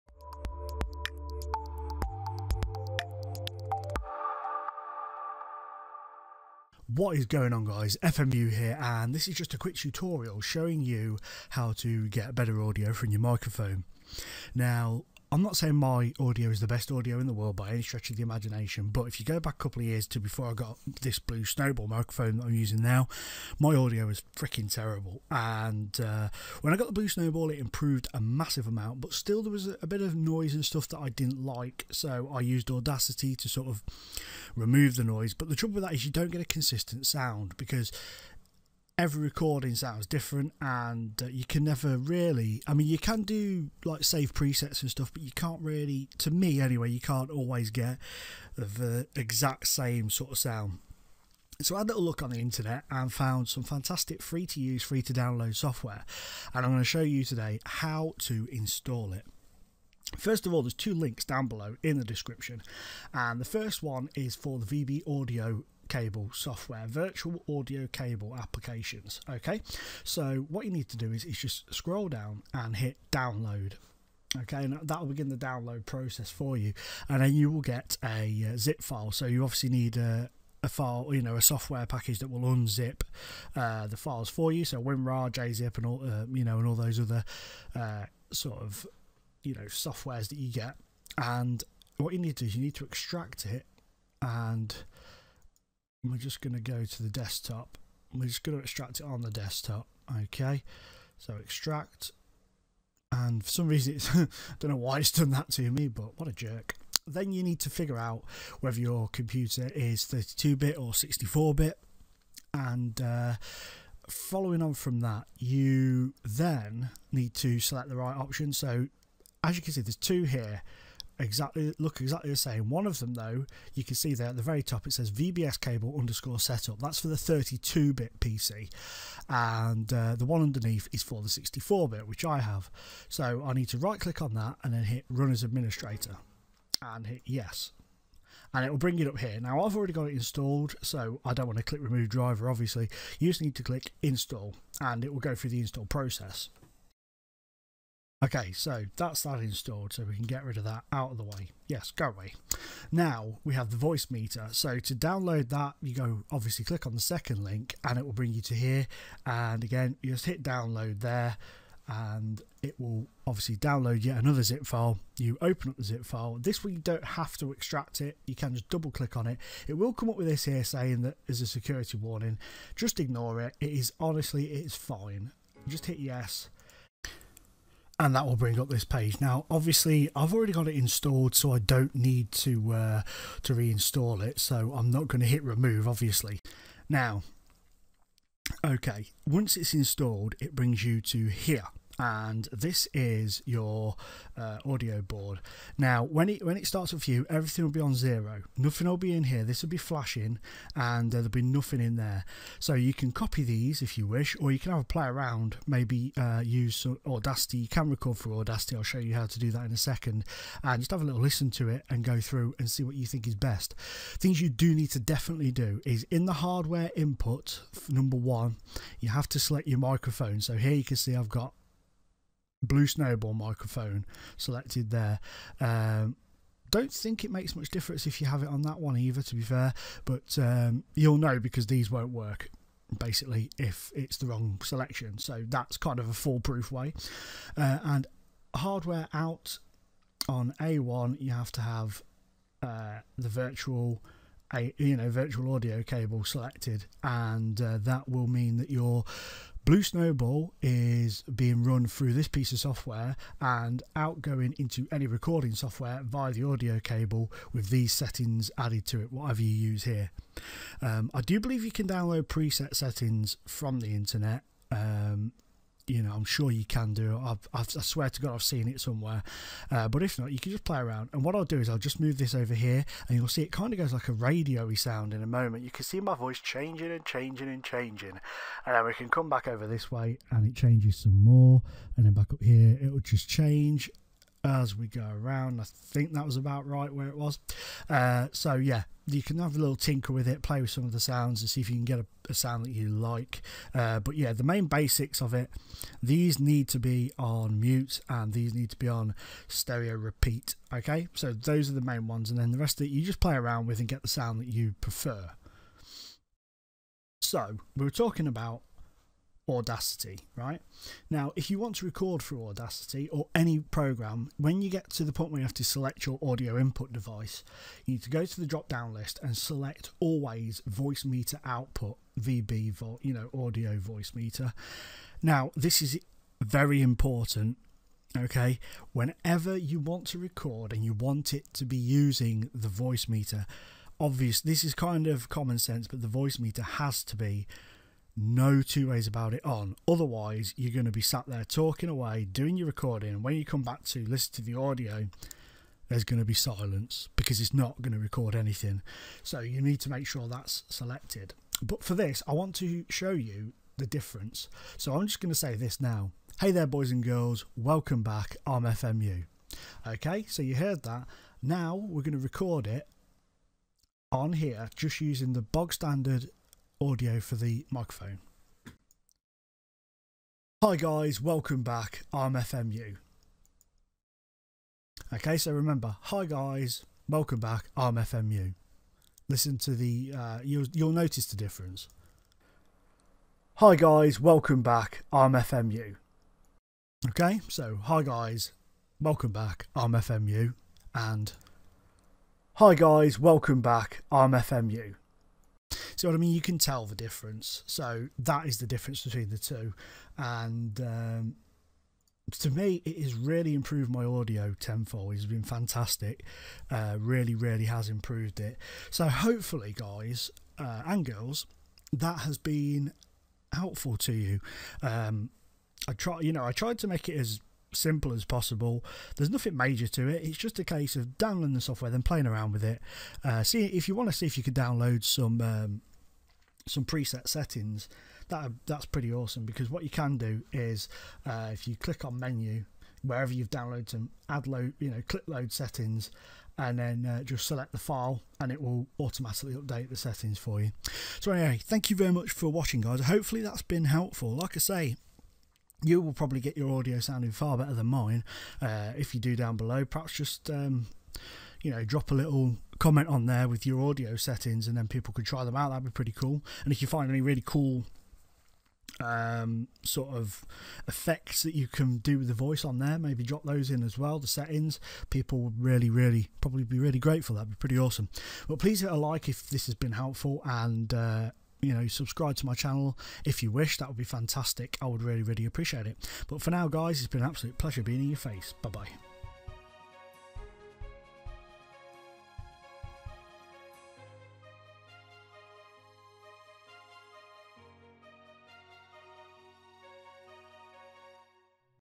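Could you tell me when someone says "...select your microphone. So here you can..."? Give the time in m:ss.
3:39.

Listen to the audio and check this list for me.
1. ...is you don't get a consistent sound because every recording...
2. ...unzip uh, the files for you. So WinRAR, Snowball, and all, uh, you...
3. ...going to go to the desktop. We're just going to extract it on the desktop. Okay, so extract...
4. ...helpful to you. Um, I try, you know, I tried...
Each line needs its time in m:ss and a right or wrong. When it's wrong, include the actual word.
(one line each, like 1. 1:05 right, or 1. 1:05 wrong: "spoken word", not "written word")
1. 0:35 right
2. 1:22 wrong: "JZIP", not "Snowball"
3. 1:36 right
4. 6:53 right.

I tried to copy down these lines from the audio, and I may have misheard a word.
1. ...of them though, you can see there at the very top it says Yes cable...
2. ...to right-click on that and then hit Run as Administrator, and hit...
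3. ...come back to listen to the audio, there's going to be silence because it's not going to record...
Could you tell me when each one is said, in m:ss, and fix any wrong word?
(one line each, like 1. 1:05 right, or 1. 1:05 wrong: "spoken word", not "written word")
1. 2:02 wrong: "VBS", not "Yes"
2. 2:13 right
3. 5:43 right.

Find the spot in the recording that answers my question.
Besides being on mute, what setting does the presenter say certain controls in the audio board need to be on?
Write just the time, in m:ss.
4:59.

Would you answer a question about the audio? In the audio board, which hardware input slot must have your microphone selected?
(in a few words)
Number one.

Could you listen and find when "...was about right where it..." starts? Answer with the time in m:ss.
4:46.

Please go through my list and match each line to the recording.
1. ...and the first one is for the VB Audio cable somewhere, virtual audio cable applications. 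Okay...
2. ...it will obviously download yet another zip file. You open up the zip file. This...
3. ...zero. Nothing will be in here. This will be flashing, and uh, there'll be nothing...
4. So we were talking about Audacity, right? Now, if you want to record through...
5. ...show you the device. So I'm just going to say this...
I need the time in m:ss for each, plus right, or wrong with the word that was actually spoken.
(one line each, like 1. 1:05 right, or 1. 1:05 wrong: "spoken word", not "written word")
1. 1:03 wrong: "software", not "somewhere"
2. 2:42 right
3. 3:17 right
4. 5:07 right
5. 5:52 wrong: "difference", not "device".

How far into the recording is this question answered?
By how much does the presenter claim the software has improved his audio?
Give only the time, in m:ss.
6:44.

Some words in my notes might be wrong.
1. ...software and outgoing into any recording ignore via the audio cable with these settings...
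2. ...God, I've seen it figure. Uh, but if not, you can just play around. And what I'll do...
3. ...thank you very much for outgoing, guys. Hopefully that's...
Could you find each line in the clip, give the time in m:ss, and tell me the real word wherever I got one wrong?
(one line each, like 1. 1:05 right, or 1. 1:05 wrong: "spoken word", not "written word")
1. 4:12 wrong: "software", not "ignore"
2. 4:28 wrong: "somewhere", not "figure"
3. 7:21 wrong: "watching", not "outgoing".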